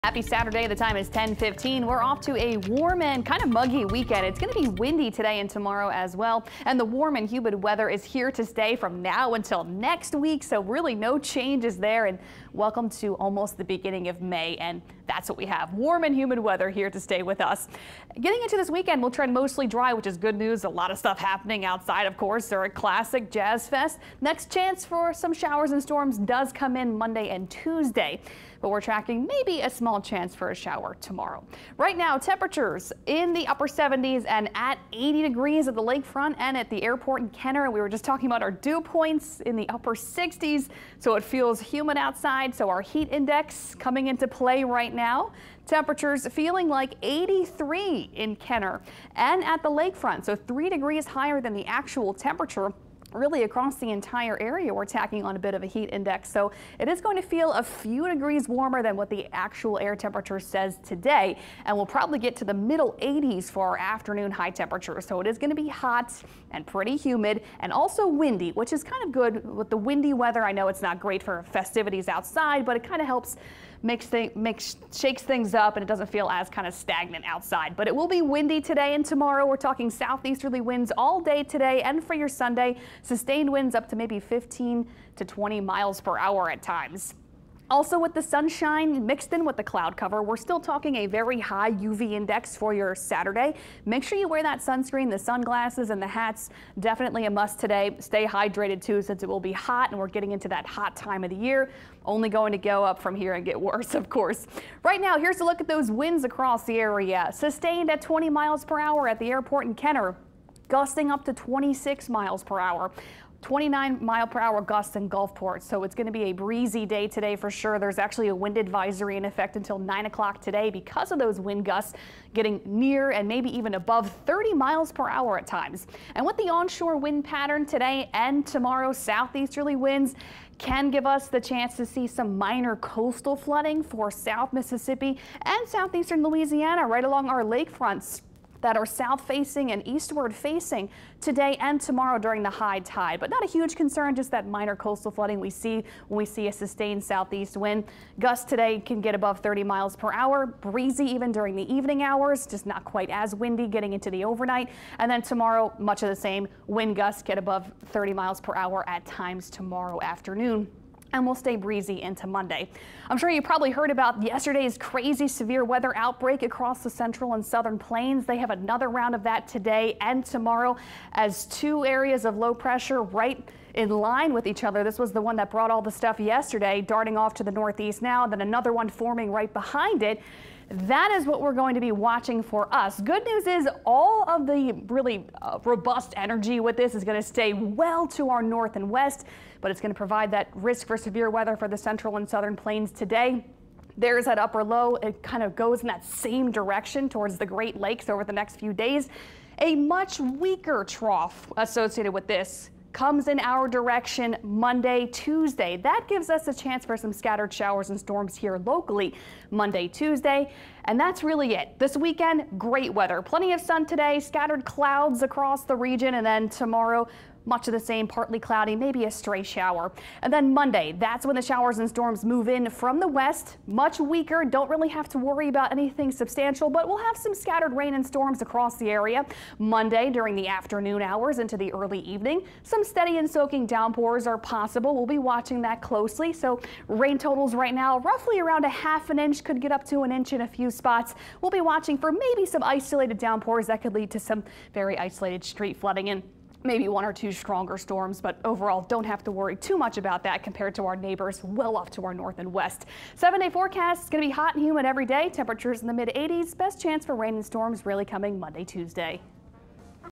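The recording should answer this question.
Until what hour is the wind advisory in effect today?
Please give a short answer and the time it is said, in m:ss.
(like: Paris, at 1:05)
9 o'clock, at 1:59.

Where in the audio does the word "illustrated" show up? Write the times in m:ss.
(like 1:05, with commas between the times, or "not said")
not said.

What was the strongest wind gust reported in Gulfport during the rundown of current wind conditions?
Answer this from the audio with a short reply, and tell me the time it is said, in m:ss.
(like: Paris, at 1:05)
29 mph, at 1:53.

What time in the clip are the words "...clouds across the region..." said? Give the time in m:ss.
3:34.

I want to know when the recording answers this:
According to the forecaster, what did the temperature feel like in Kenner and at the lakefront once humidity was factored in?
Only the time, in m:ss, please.
0:47.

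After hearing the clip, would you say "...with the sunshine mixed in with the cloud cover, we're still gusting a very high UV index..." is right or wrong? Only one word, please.
wrong.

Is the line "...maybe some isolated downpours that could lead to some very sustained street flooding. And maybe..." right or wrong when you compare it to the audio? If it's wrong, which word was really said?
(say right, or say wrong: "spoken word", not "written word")
wrong: "isolated", not "sustained".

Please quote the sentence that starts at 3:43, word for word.
Much weaker, don't really have to worry about anything substantial, but we'll have some scattered rain and storms across the area.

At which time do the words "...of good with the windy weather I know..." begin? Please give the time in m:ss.
1:09.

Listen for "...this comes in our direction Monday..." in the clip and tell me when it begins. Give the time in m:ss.
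3:22.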